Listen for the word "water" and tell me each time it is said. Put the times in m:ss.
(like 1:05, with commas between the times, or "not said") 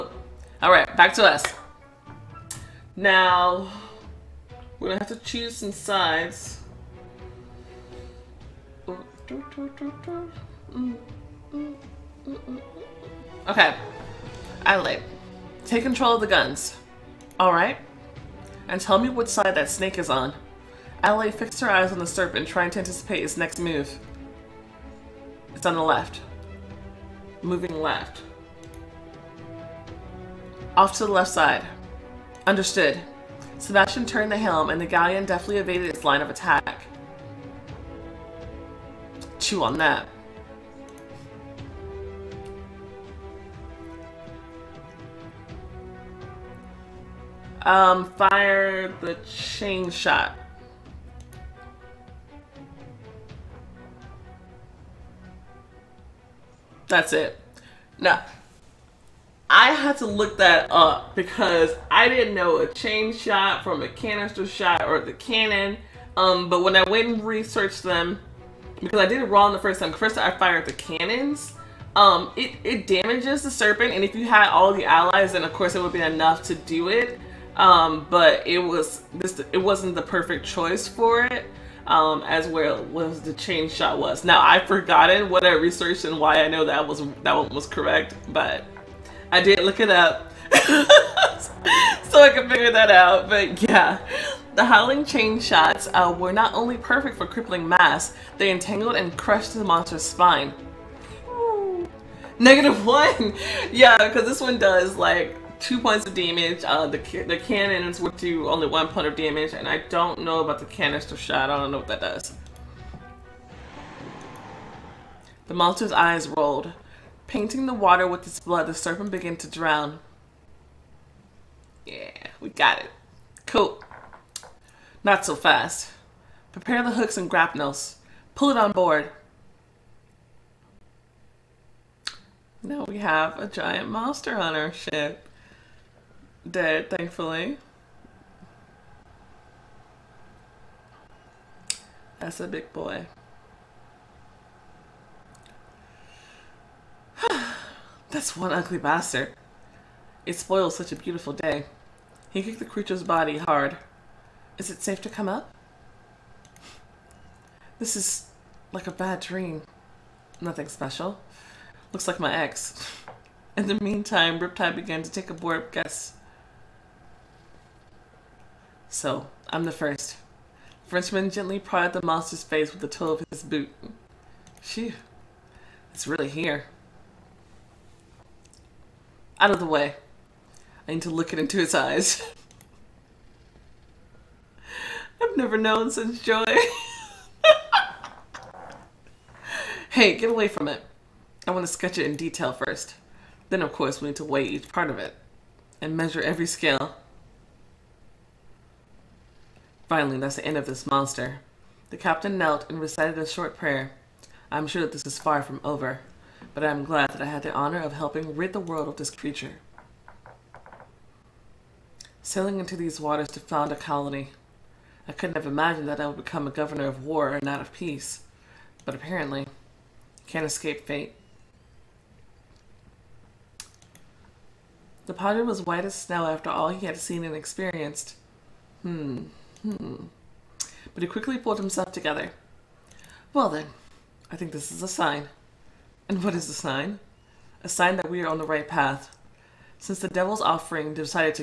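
1:57, 3:33.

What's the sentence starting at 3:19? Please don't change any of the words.
Finally, that's the end of this monster.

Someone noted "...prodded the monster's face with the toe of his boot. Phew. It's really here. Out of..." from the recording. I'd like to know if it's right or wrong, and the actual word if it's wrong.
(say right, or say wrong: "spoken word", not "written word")
right.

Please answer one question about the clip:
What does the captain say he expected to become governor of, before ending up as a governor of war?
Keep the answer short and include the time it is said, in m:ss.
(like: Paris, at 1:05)
Peace, at 3:37.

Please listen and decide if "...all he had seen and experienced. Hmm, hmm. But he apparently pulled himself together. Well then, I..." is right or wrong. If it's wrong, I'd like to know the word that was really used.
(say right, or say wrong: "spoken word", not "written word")
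wrong: "quickly", not "apparently".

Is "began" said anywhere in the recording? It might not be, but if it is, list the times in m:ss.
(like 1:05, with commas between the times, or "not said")
1:59, 2:44.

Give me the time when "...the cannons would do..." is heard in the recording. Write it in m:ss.
1:47.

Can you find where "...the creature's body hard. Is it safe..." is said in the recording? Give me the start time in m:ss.
2:32.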